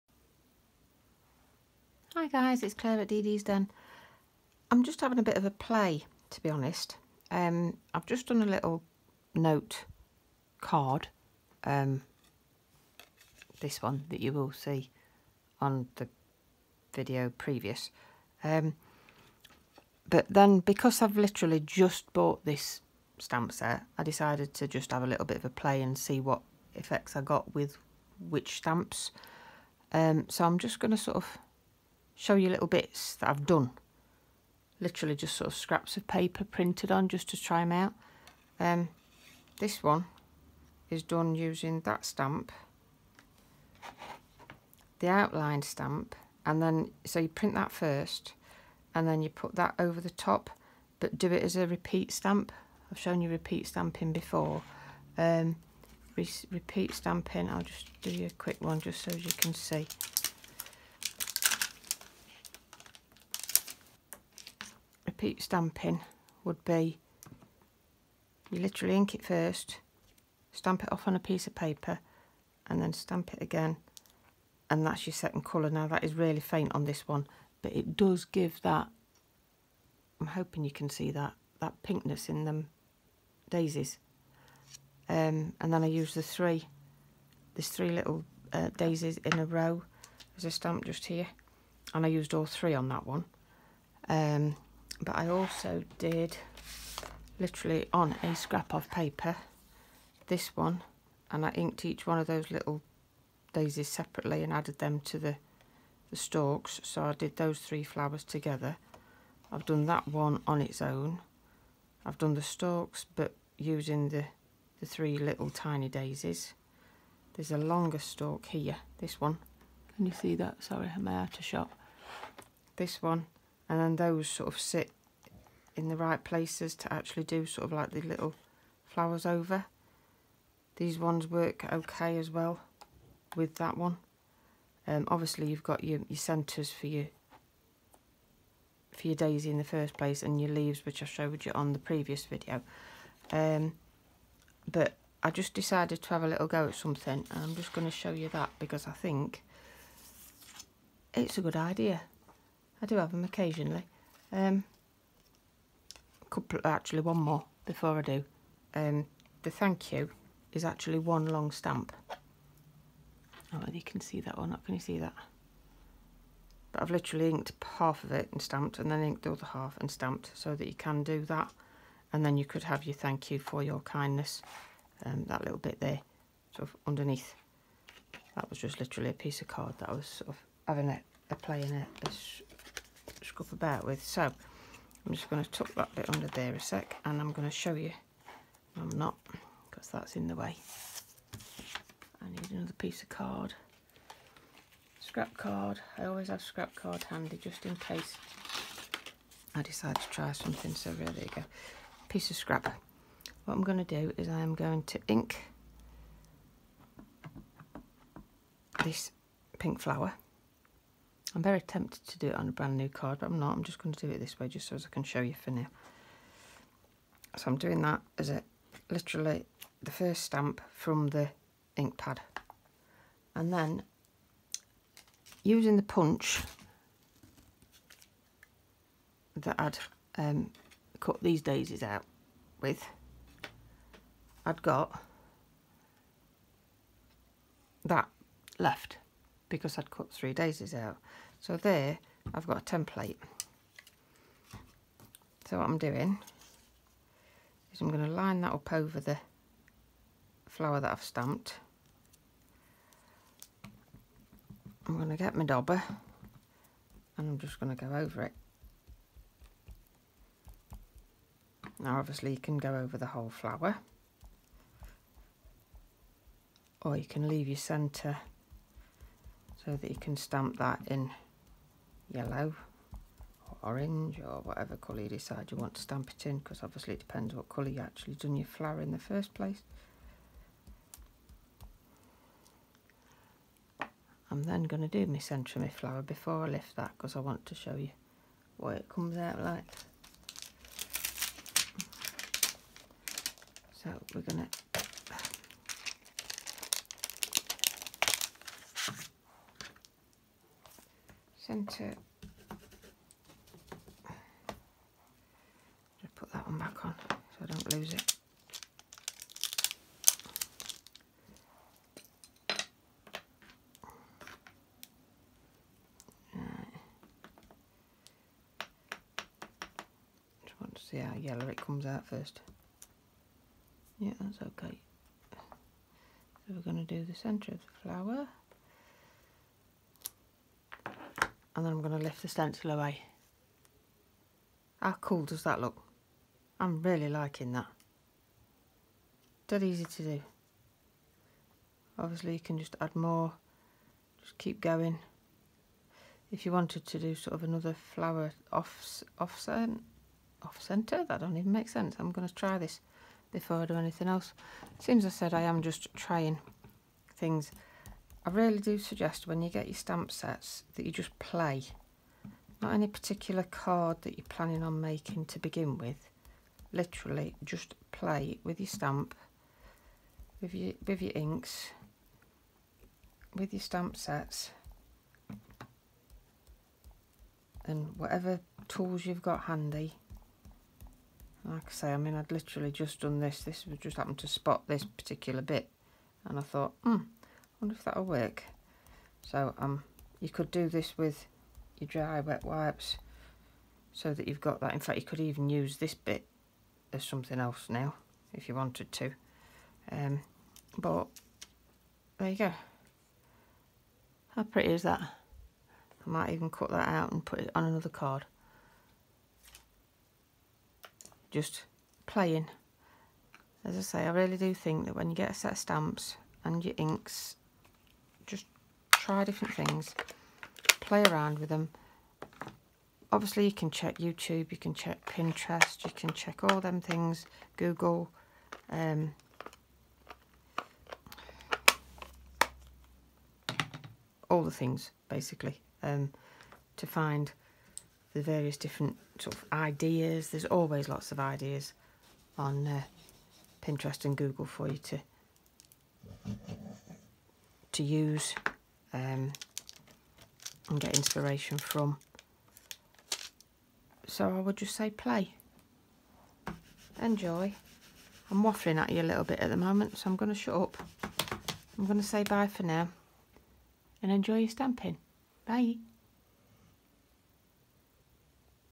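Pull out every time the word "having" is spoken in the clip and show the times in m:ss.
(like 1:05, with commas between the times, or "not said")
0:04, 3:00.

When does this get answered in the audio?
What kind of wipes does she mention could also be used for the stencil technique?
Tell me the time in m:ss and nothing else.
6:31.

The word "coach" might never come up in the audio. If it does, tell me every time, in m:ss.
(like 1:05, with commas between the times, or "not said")
not said.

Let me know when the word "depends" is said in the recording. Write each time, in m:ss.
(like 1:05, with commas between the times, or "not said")
4:36.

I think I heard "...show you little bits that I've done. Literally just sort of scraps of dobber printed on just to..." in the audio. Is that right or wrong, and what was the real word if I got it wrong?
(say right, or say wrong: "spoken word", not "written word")
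wrong: "paper", not "dobber".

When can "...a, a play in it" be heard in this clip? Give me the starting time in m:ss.
3:00.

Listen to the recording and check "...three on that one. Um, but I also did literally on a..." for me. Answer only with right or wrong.
right.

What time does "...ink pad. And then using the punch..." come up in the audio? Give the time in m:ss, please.
3:41.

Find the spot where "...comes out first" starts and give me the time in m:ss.
5:21.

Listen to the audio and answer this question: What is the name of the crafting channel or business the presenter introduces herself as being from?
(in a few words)
Dee Dee's Den.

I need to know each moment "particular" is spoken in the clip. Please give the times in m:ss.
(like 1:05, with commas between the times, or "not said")
6:02, 6:24.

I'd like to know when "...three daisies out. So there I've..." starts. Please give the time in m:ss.
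4:00.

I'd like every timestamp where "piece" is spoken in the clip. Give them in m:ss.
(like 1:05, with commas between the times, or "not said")
1:11, 2:59, 3:12, 3:22.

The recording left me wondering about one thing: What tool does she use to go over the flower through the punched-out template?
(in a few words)
dobber.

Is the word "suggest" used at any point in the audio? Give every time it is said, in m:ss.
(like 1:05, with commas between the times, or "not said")
5:58.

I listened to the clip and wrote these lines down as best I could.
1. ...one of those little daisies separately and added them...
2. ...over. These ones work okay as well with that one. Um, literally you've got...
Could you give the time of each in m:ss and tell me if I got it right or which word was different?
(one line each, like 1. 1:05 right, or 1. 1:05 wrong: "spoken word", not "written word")
1. 1:42 right
2. 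2:09 wrong: "obviously", not "literally".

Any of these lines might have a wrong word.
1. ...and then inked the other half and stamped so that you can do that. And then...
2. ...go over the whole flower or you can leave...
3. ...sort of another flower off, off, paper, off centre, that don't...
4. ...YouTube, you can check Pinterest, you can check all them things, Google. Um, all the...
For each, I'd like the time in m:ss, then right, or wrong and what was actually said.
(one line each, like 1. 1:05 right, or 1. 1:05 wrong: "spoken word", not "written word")
1. 2:48 right
2. 4:22 right
3. 5:47 wrong: "center", not "paper"
4. 7:03 right.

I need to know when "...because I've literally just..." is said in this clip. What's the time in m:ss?
0:20.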